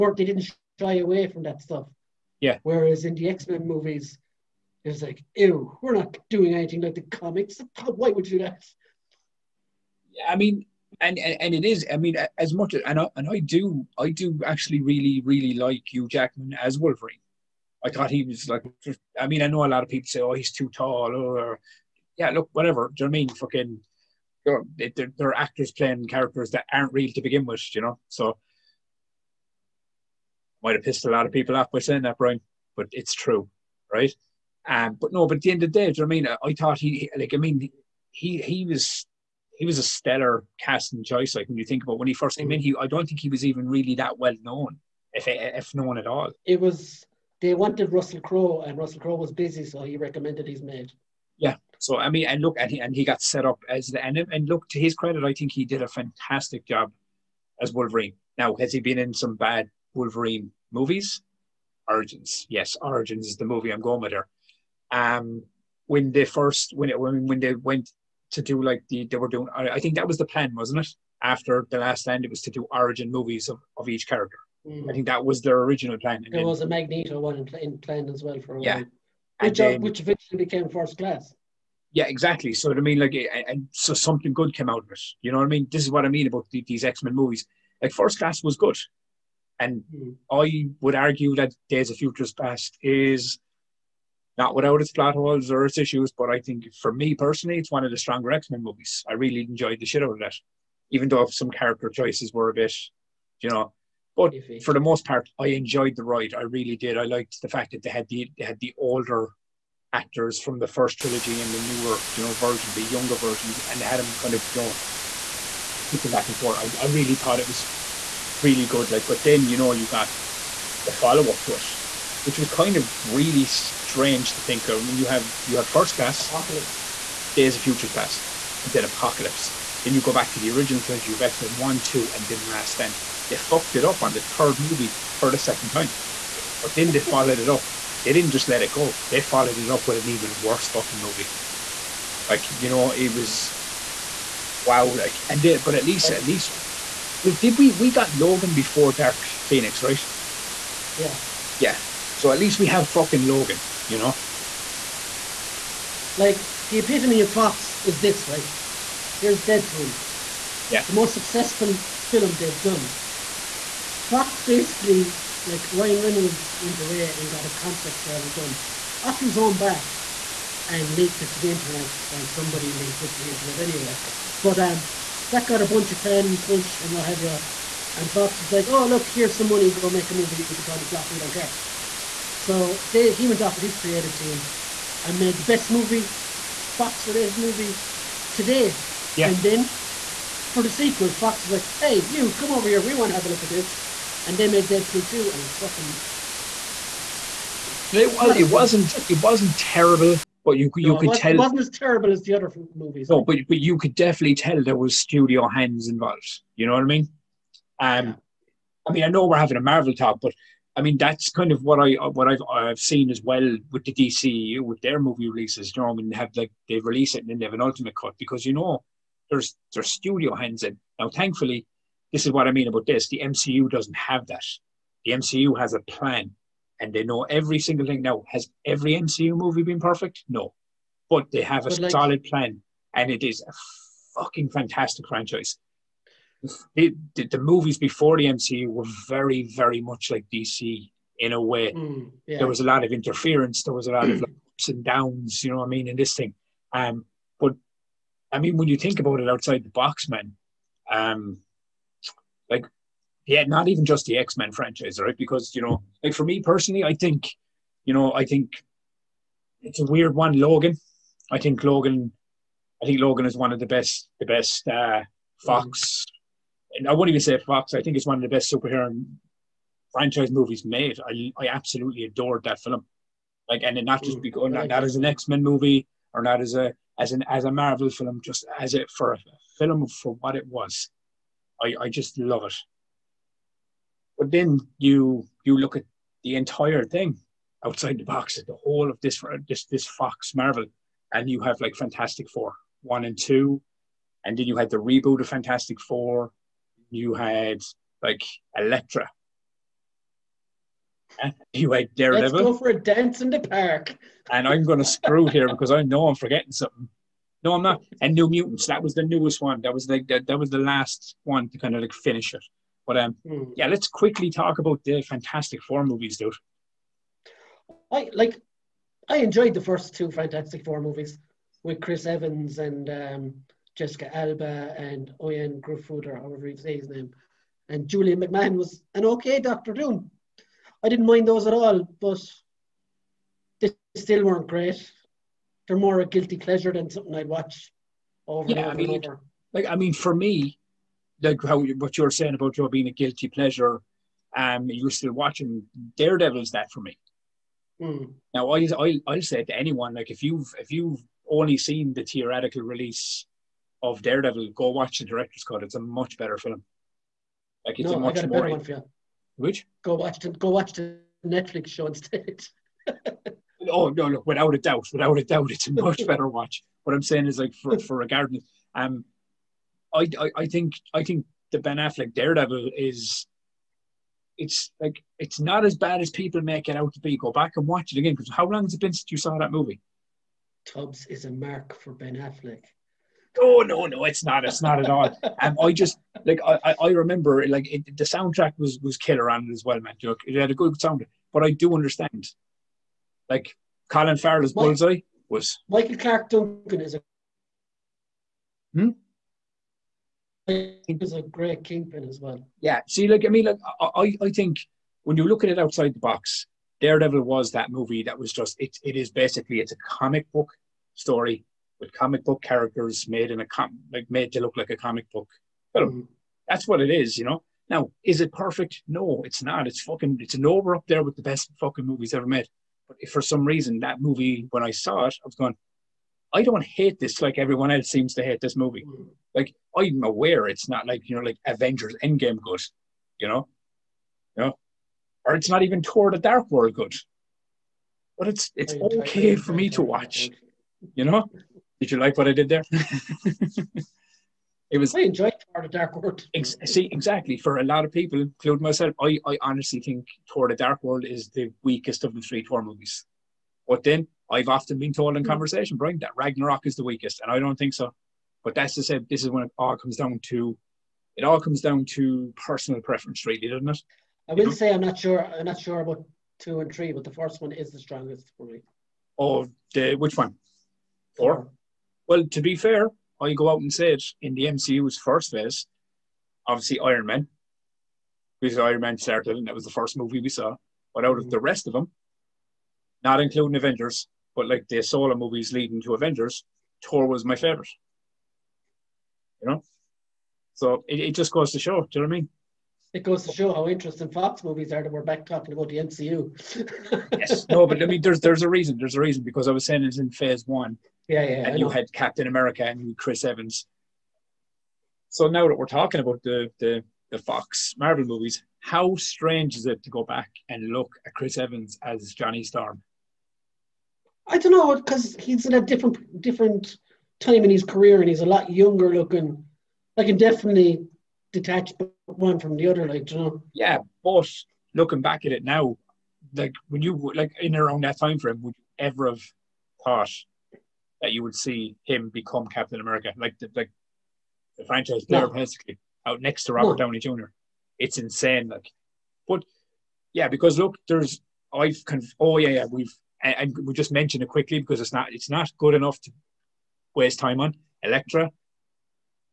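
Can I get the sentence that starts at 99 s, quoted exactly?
I really enjoyed the shit out of that, even though some character choices were a bit, you know.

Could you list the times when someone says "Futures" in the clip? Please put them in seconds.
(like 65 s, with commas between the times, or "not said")
91 s, 127 s.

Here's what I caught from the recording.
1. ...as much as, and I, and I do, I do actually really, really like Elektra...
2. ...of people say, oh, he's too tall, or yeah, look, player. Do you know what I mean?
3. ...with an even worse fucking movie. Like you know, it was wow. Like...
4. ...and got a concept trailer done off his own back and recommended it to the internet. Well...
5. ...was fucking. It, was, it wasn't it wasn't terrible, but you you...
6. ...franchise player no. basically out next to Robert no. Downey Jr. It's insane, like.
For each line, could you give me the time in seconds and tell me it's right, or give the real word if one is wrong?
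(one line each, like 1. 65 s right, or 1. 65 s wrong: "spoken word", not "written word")
1. 12 s wrong: "Hugh", not "Elektra"
2. 19 s wrong: "whatever", not "player"
3. 139 s right
4. 167 s wrong: "leaked", not "recommended"
5. 195 s right
6. 534 s right.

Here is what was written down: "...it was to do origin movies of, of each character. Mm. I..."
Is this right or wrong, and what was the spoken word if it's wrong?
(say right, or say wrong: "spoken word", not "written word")
right.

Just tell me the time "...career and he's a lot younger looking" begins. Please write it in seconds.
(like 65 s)
517 s.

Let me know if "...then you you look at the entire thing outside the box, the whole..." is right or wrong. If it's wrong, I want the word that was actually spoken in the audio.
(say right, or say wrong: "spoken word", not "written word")
right.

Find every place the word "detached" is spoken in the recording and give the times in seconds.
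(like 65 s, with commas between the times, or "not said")
521 s.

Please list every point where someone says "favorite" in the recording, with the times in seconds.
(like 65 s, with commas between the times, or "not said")
487 s.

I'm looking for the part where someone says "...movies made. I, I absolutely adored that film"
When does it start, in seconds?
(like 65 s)
270 s.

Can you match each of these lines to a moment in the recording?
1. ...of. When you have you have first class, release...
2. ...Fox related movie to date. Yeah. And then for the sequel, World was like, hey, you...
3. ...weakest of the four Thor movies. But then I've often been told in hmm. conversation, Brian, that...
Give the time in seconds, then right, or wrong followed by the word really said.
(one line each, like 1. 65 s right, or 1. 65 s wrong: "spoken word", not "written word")
1. 124 s wrong: "apocalypse", not "release"
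2. 186 s wrong: "Fox", not "World"
3. 451 s wrong: "three", not "four".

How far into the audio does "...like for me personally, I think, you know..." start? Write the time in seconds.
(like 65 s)
256 s.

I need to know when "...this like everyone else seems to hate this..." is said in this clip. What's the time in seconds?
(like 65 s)
426 s.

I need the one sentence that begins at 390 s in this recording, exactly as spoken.
it had a good sound, but I do understand.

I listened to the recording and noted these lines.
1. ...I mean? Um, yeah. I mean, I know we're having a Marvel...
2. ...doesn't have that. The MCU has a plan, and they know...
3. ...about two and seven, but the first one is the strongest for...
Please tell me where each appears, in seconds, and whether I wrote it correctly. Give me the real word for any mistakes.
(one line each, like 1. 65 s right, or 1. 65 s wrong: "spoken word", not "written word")
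1. 206 s right
2. 223 s right
3. 465 s wrong: "three", not "seven".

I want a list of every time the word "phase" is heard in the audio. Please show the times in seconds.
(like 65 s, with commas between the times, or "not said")
475 s, 500 s.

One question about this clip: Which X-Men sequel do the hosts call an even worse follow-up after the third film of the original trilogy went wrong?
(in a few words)
Dark Phoenix.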